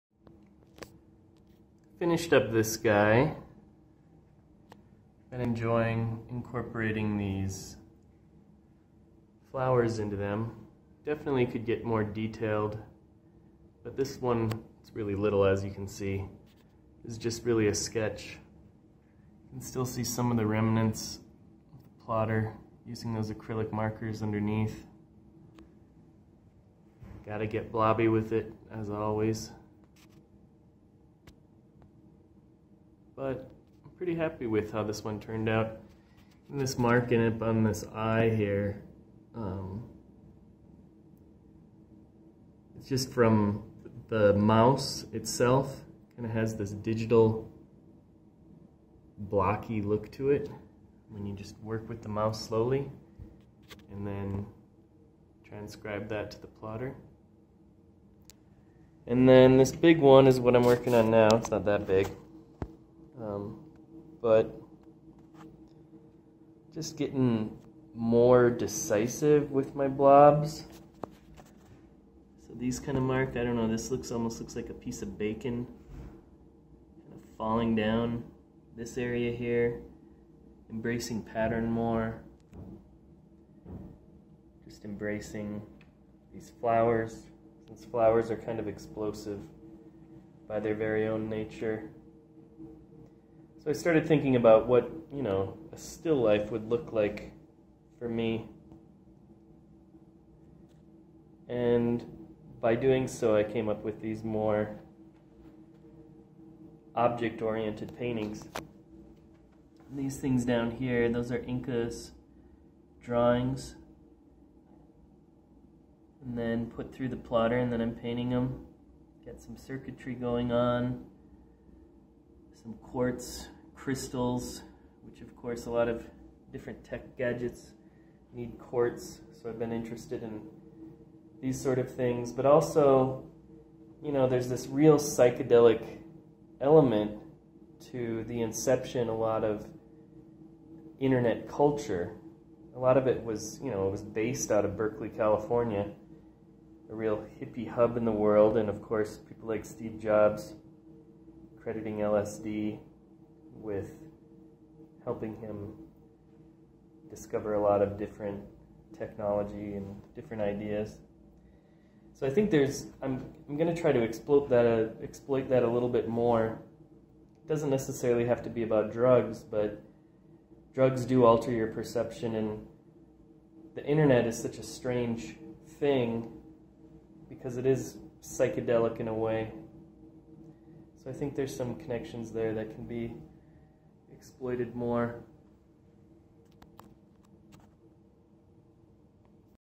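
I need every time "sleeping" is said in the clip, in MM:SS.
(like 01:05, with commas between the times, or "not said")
not said.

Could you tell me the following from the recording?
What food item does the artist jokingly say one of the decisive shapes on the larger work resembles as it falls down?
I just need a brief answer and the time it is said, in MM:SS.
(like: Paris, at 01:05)
bacon, at 01:15.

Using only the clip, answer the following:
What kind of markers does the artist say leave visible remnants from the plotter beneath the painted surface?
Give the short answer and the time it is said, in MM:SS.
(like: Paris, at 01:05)
acrylic markers, at 00:23.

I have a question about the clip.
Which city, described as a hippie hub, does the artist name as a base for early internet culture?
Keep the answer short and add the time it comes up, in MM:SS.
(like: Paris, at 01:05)
Berkeley, California, at 02:24.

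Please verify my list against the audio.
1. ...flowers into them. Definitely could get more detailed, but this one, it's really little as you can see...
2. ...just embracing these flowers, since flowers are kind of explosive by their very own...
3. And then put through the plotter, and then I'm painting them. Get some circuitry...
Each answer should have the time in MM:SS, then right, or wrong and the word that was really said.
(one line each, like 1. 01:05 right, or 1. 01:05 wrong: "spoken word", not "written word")
1. 00:09 right
2. 01:24 right
3. 01:56 right.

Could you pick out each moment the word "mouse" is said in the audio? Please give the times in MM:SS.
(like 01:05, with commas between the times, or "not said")
00:44, 00:52.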